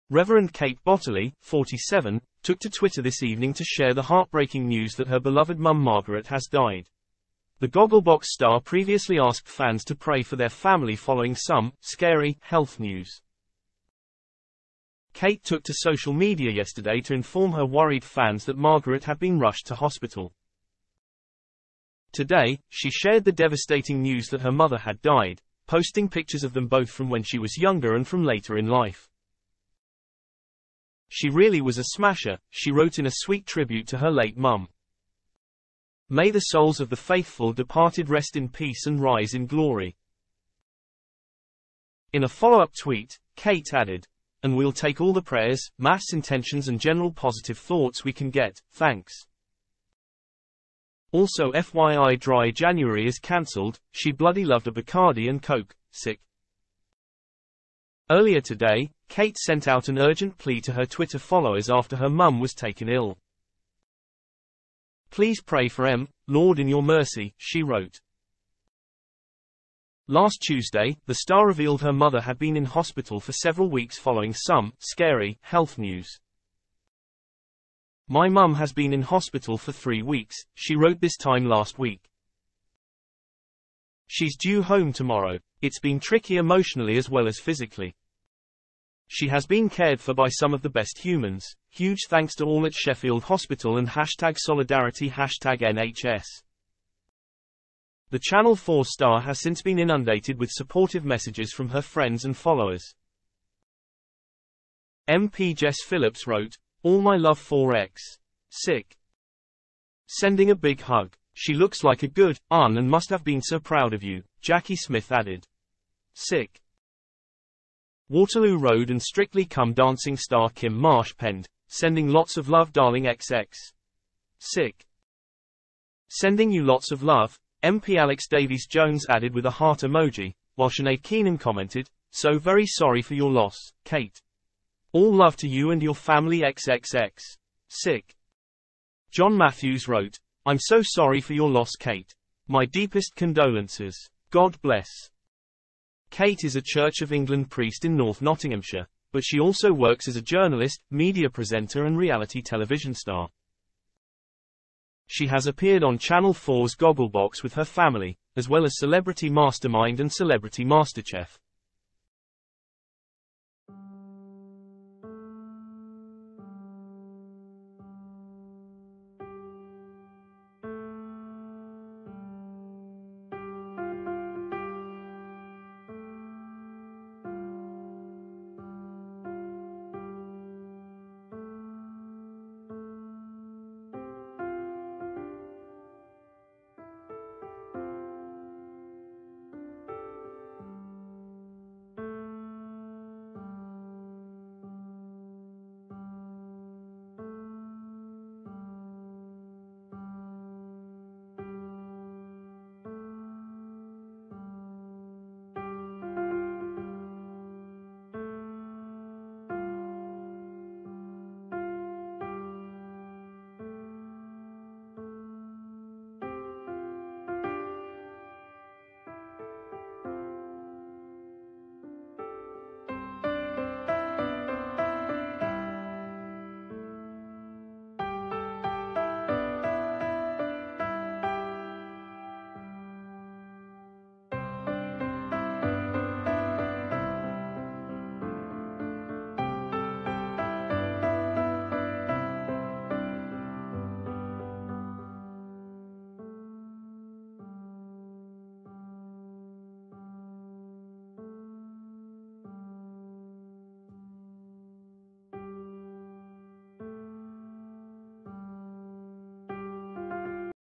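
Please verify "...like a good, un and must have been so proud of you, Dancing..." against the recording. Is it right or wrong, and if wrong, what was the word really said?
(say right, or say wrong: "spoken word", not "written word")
wrong: "Jackie", not "Dancing".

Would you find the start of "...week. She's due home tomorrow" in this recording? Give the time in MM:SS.
01:21.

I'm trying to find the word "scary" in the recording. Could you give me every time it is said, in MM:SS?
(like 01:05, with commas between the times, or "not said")
00:11, 01:14.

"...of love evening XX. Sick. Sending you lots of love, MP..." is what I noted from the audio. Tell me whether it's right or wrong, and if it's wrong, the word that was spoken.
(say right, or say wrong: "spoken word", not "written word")
wrong: "darling", not "evening".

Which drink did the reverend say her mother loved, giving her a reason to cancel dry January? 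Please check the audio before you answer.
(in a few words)
Bacardi and Coke.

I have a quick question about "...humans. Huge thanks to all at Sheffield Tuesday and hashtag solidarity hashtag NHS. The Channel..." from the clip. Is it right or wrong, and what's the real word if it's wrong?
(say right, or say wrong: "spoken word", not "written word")
wrong: "Hospital", not "Tuesday".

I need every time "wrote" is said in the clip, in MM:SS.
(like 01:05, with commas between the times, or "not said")
00:32, 01:07, 01:20, 01:46, 02:19.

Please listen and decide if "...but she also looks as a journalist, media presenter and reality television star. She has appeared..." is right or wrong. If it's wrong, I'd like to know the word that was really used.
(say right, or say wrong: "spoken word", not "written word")
wrong: "works", not "looks".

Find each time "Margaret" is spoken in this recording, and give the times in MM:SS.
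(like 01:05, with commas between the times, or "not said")
00:05, 00:18.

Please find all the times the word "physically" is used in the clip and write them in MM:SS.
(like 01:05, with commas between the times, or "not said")
01:27.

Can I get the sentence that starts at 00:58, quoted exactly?
Earlier today, Kate sent out an urgent plea to her Twitter followers after her mum was taken ill.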